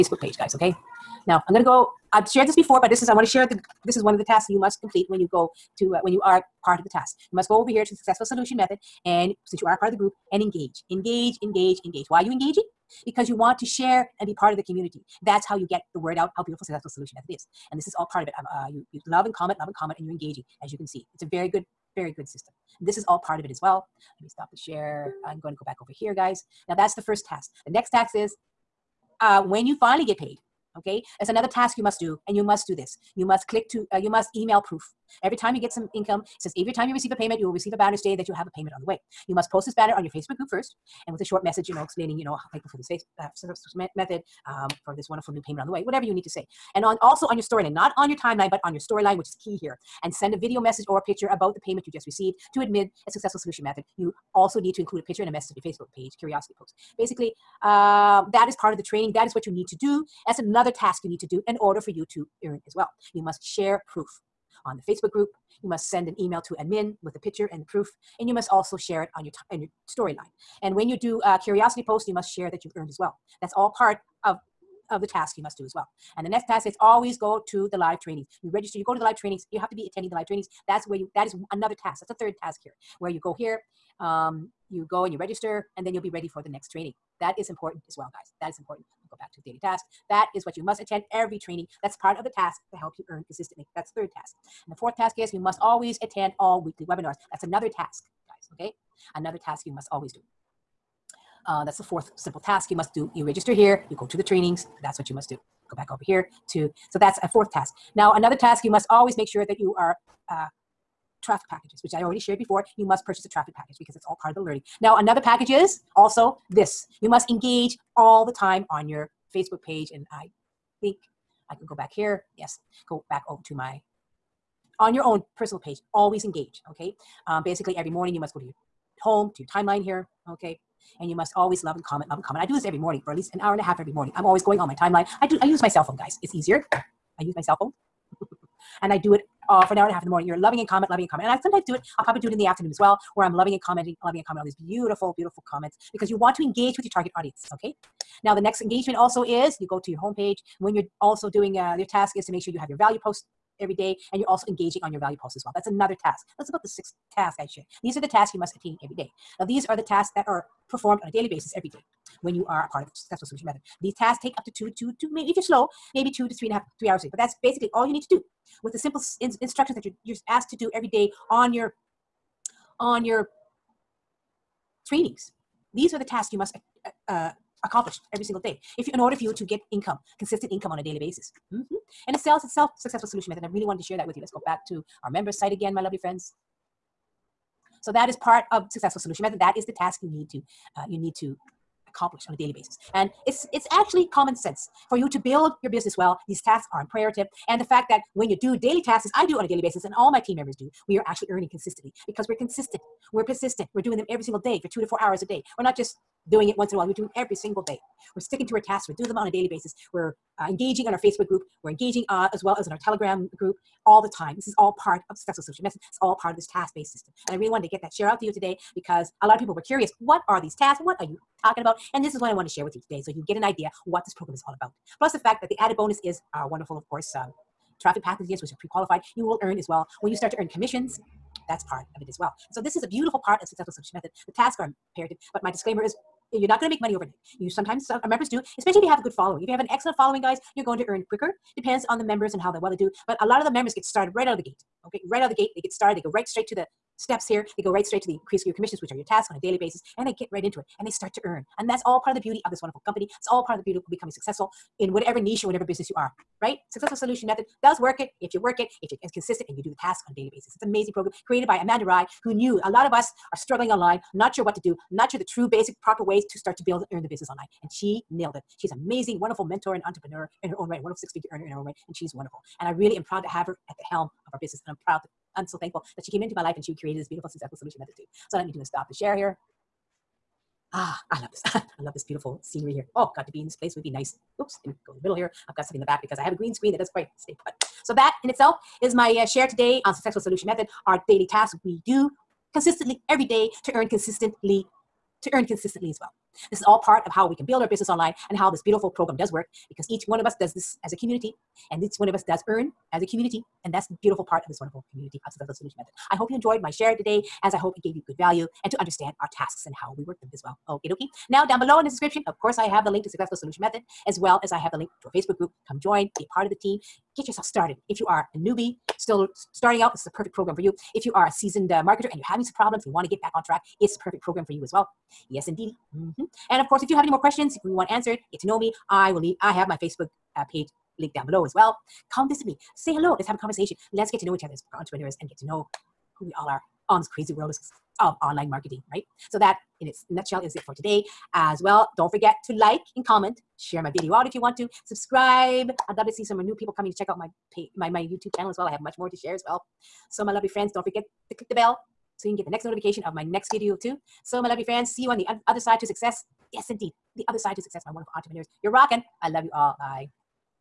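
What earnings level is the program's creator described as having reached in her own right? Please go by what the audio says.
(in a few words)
six figure.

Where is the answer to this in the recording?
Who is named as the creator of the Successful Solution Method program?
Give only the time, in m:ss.
4:21.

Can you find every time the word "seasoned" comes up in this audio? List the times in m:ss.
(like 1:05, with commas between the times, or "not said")
5:21.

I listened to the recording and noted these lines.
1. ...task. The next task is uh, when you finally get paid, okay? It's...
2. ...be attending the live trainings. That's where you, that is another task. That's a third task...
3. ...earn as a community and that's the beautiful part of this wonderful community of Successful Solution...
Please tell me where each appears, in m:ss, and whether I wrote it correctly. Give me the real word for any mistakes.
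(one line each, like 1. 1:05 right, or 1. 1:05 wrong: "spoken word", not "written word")
1. 0:27 right
2. 1:19 right
3. 5:02 right.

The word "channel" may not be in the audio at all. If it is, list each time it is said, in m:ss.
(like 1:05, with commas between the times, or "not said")
5:48.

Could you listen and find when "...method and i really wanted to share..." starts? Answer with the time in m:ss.
3:03.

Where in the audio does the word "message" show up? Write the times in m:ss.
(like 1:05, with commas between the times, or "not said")
0:41, 0:50, 0:55, 3:35.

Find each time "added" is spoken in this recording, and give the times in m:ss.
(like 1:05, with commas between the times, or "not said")
3:45.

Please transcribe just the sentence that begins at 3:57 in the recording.
You sometimes members do, especially if you have a good following.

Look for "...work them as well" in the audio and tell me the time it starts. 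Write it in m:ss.
5:10.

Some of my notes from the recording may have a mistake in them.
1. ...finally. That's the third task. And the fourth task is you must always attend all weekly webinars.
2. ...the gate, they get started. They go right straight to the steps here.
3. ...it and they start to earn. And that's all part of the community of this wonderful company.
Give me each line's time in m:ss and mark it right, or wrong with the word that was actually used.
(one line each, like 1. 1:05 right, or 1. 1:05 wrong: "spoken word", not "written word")
1. 1:33 wrong: "consistently", not "finally"
2. 4:05 right
3. 4:10 wrong: "beauty", not "community".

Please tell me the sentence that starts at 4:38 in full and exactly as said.
So let me do a stop the share here.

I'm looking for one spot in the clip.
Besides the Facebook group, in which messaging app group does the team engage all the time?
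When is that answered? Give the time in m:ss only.
3:32.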